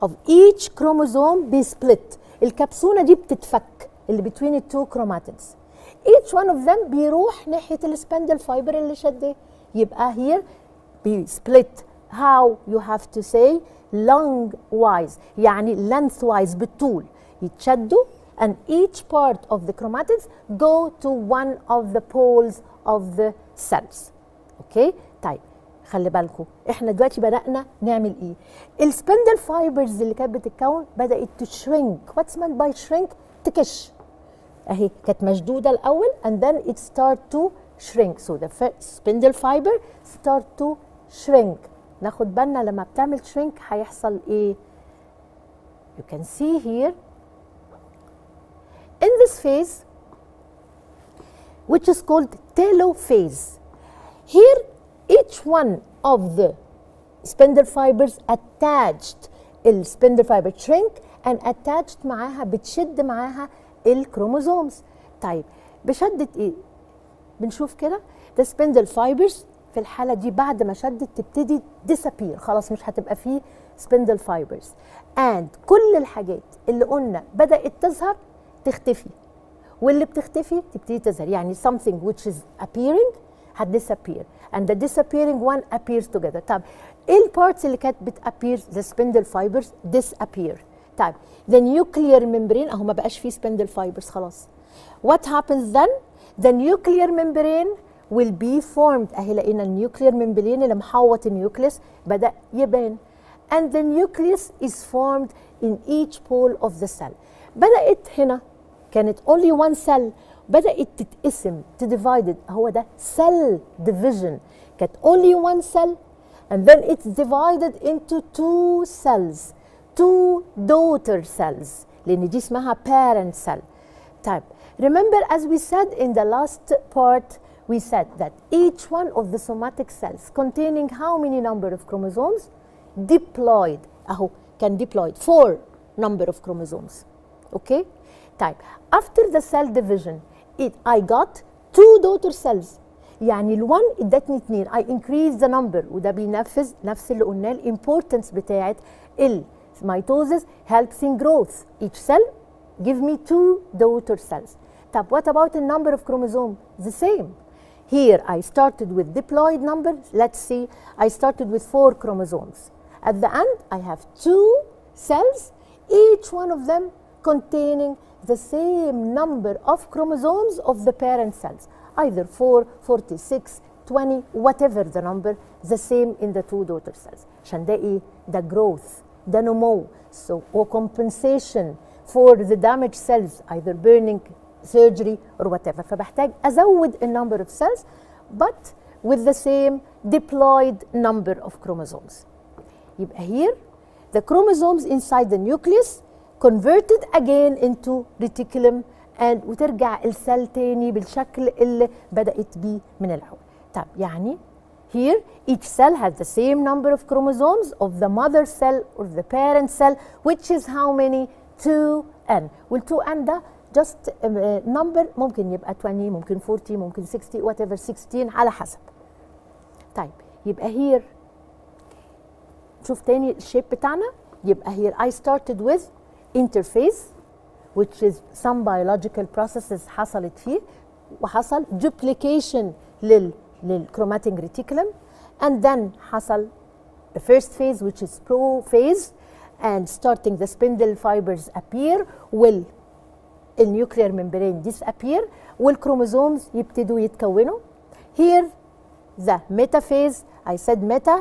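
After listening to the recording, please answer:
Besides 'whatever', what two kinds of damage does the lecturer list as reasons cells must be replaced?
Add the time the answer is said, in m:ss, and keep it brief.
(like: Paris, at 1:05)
burning, surgery, at 3:03.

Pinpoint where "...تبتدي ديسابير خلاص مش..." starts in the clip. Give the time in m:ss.
1:11.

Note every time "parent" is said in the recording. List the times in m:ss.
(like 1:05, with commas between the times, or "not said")
2:02, 2:50, 3:29.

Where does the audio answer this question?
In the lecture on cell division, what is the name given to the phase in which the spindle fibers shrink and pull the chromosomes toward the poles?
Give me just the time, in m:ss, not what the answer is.
0:52.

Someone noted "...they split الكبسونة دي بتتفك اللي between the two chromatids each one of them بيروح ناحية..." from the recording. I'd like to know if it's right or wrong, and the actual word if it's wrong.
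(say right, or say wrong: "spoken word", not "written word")
right.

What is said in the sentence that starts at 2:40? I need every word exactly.
Let's see, I started with four chromosomes.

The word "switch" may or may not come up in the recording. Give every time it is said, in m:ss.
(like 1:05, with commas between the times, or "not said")
not said.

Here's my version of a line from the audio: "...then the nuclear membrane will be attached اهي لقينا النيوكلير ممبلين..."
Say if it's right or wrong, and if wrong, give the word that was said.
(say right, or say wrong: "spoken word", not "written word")
wrong: "formed", not "attached".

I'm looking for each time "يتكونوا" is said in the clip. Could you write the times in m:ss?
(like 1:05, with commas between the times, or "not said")
4:06.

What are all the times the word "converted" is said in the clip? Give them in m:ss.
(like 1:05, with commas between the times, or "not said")
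3:16.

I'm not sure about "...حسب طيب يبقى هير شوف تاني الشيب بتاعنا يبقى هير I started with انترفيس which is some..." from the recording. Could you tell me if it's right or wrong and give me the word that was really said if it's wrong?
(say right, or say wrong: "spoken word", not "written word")
right.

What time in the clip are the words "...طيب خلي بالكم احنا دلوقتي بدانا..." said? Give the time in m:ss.
0:25.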